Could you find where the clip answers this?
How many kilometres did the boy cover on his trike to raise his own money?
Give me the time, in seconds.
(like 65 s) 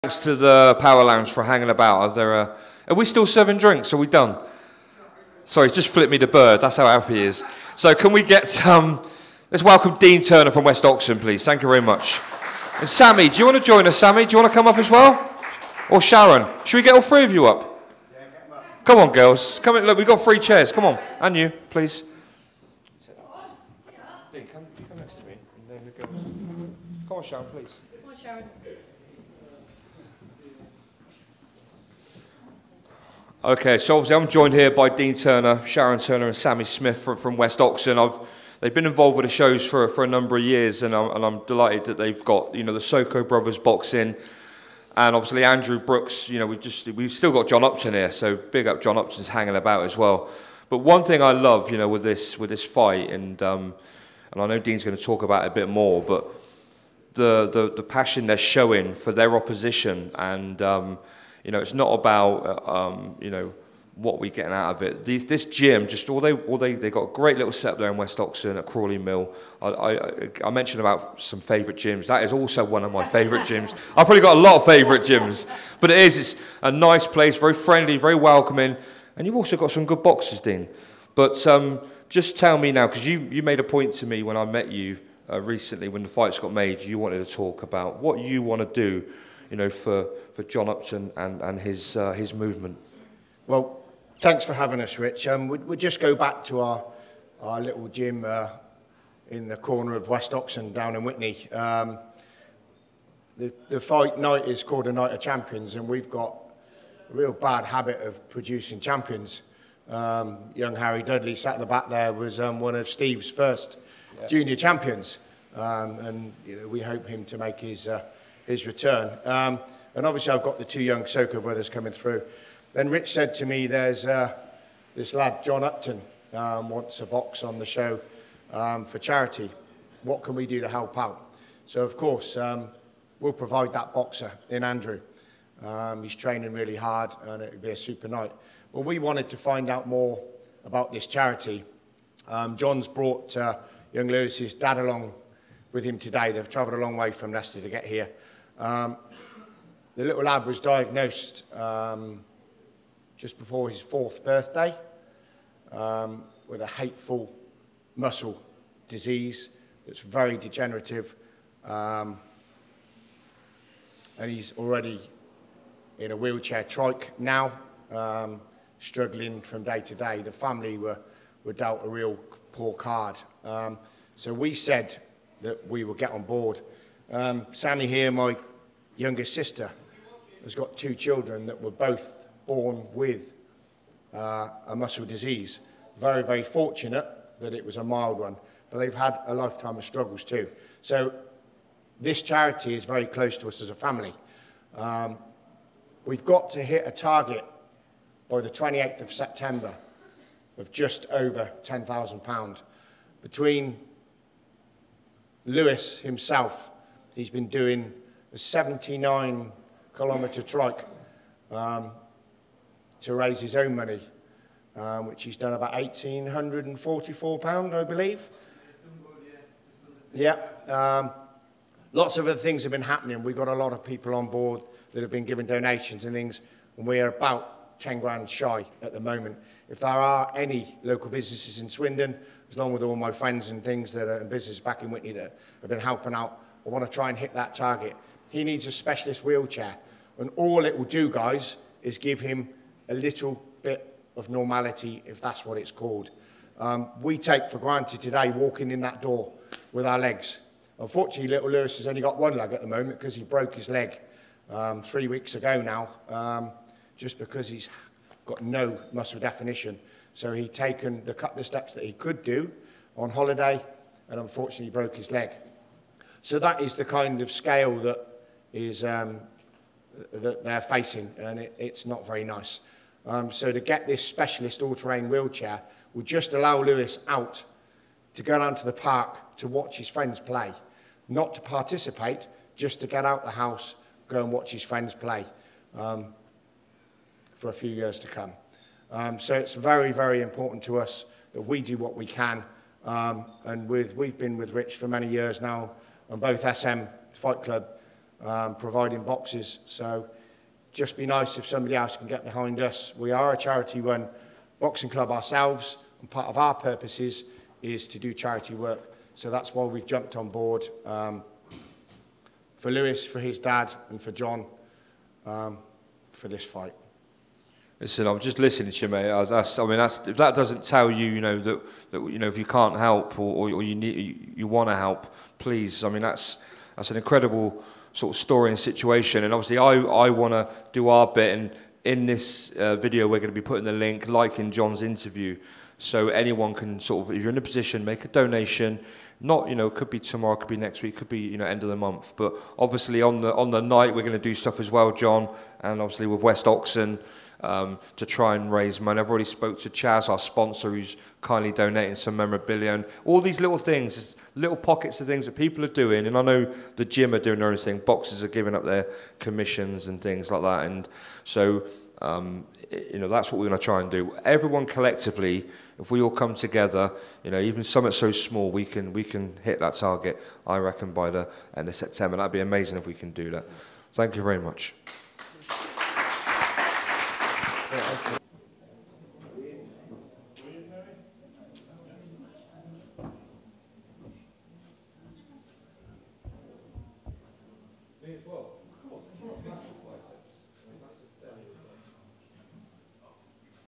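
208 s.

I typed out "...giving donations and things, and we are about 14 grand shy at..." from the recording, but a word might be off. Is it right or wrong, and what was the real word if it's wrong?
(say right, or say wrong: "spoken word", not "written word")
wrong: "10", not "14".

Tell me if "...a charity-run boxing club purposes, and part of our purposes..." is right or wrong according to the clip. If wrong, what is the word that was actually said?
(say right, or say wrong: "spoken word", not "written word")
wrong: "ourselves", not "purposes".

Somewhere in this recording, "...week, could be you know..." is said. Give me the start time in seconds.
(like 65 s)
340 s.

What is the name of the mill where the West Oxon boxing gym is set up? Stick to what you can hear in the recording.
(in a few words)
Crawley Mill.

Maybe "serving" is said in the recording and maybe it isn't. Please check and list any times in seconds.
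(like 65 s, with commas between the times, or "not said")
3 s.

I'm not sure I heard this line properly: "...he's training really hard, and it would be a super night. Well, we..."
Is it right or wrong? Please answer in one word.
right.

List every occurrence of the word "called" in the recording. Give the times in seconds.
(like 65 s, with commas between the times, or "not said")
104 s, 245 s.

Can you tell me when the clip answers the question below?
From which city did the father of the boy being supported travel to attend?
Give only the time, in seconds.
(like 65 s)
147 s.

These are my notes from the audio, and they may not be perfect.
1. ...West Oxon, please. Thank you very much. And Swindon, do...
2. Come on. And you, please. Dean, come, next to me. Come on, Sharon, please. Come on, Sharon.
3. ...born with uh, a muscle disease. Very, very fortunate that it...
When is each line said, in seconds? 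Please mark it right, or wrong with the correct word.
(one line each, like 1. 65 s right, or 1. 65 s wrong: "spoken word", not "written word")
1. 10 s wrong: "Sammy", not "Swindon"
2. 20 s right
3. 182 s right.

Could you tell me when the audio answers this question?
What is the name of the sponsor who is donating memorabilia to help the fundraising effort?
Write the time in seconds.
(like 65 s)
349 s.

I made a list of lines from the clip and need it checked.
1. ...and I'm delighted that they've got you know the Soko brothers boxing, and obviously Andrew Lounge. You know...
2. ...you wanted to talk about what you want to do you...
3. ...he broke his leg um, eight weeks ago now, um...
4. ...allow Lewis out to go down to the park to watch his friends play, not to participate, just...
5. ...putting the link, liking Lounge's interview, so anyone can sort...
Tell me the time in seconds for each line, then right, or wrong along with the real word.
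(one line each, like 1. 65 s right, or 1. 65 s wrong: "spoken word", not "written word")
1. 41 s wrong: "Brooks", not "Lounge"
2. 86 s right
3. 253 s wrong: "three", not "eight"
4. 276 s right
5. 333 s wrong: "John", not "Lounge".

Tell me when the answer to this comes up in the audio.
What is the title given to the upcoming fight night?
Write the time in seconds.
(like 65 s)
104 s.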